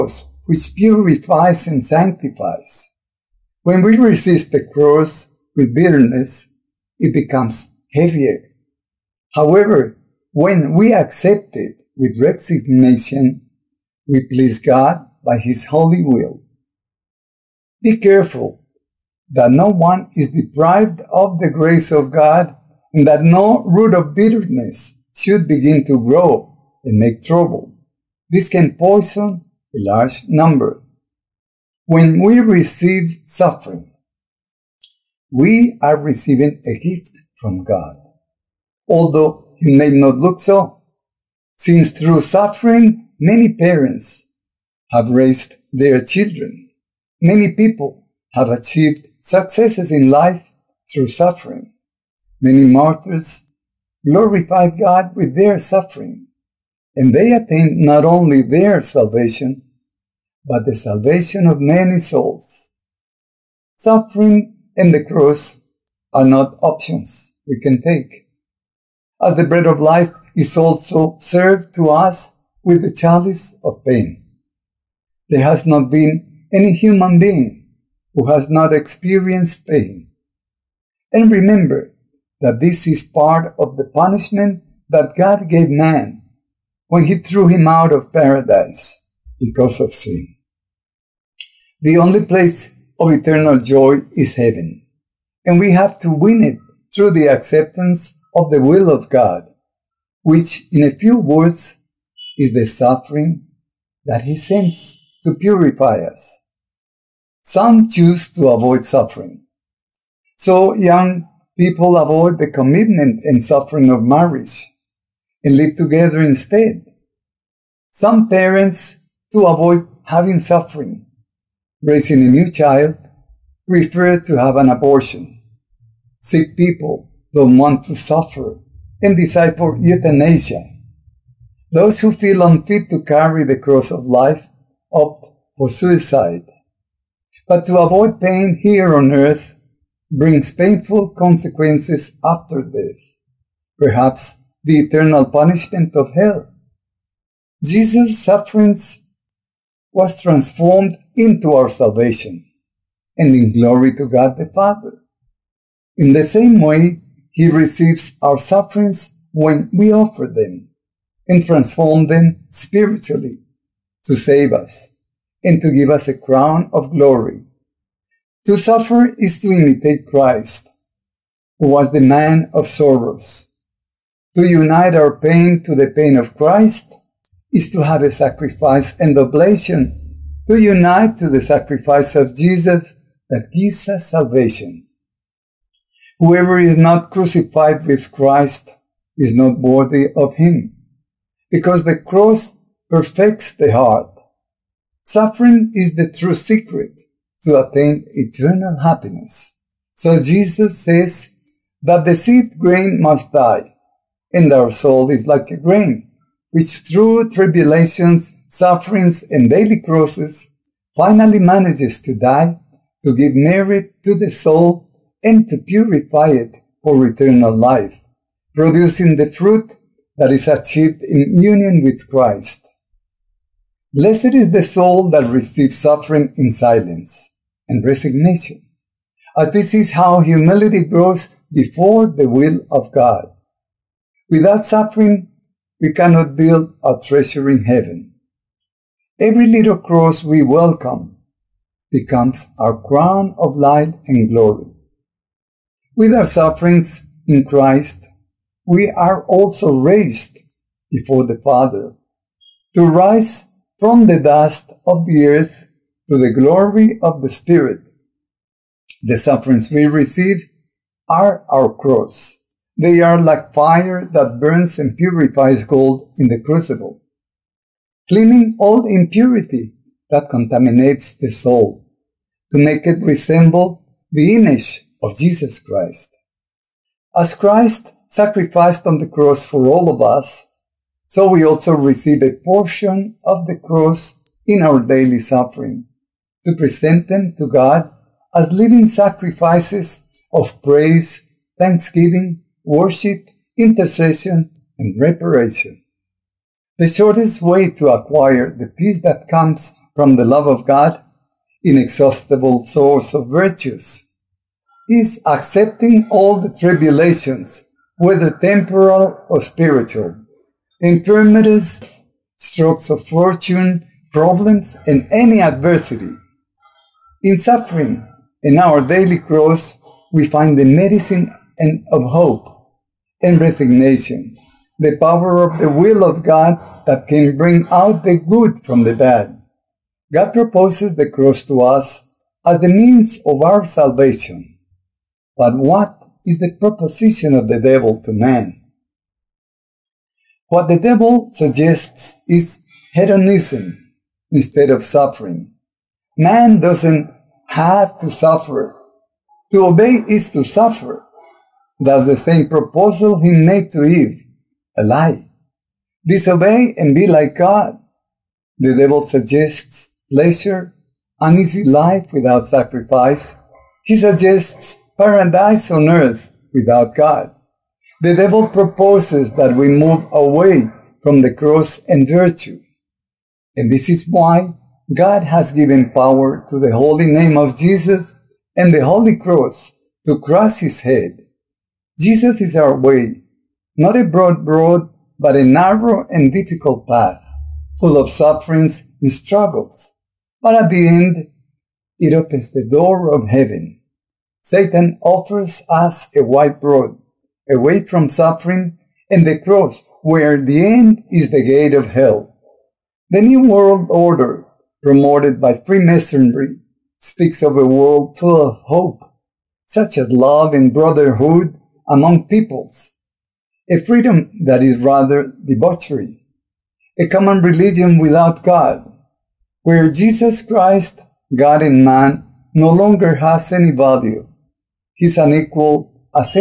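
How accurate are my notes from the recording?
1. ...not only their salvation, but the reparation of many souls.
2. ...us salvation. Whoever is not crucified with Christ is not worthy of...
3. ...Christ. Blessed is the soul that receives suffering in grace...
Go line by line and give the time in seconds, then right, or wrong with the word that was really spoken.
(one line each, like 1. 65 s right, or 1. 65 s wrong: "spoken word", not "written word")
1. 57 s wrong: "salvation", not "reparation"
2. 183 s right
3. 222 s wrong: "silence", not "grace".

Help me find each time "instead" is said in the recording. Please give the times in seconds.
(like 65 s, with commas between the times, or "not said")
116 s, 344 s.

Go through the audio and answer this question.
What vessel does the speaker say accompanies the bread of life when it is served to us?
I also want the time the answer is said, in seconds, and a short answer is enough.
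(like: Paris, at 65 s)
the chalice of pain, at 72 s.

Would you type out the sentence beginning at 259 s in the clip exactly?
The sufferings we receive are our cross.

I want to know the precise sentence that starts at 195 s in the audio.
Suffering is the true secret to attain eternal happiness.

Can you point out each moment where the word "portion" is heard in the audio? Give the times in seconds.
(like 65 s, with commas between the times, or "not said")
282 s.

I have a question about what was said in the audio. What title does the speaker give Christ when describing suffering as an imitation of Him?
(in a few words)
the man of sorrows.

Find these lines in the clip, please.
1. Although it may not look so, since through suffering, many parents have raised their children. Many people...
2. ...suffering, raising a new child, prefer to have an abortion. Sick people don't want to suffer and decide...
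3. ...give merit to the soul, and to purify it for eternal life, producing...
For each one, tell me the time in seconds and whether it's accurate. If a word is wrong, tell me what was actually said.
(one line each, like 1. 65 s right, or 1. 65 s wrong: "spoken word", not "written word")
1. 38 s right
2. 120 s right
3. 213 s right.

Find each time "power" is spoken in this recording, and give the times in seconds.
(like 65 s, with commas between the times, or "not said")
324 s, 375 s.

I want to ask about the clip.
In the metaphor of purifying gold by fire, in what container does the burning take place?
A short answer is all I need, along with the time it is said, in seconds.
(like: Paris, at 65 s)
the crucible, at 266 s.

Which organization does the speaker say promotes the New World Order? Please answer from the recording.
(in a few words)
Freemasonry.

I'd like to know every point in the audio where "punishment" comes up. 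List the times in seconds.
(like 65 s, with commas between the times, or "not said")
83 s, 145 s.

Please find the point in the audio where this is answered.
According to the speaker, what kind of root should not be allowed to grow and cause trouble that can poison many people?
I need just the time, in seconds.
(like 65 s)
23 s.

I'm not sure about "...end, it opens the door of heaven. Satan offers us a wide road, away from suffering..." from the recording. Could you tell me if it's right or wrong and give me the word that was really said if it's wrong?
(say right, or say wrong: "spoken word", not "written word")
right.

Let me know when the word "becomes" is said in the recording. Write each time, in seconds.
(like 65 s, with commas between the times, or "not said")
7 s, 241 s.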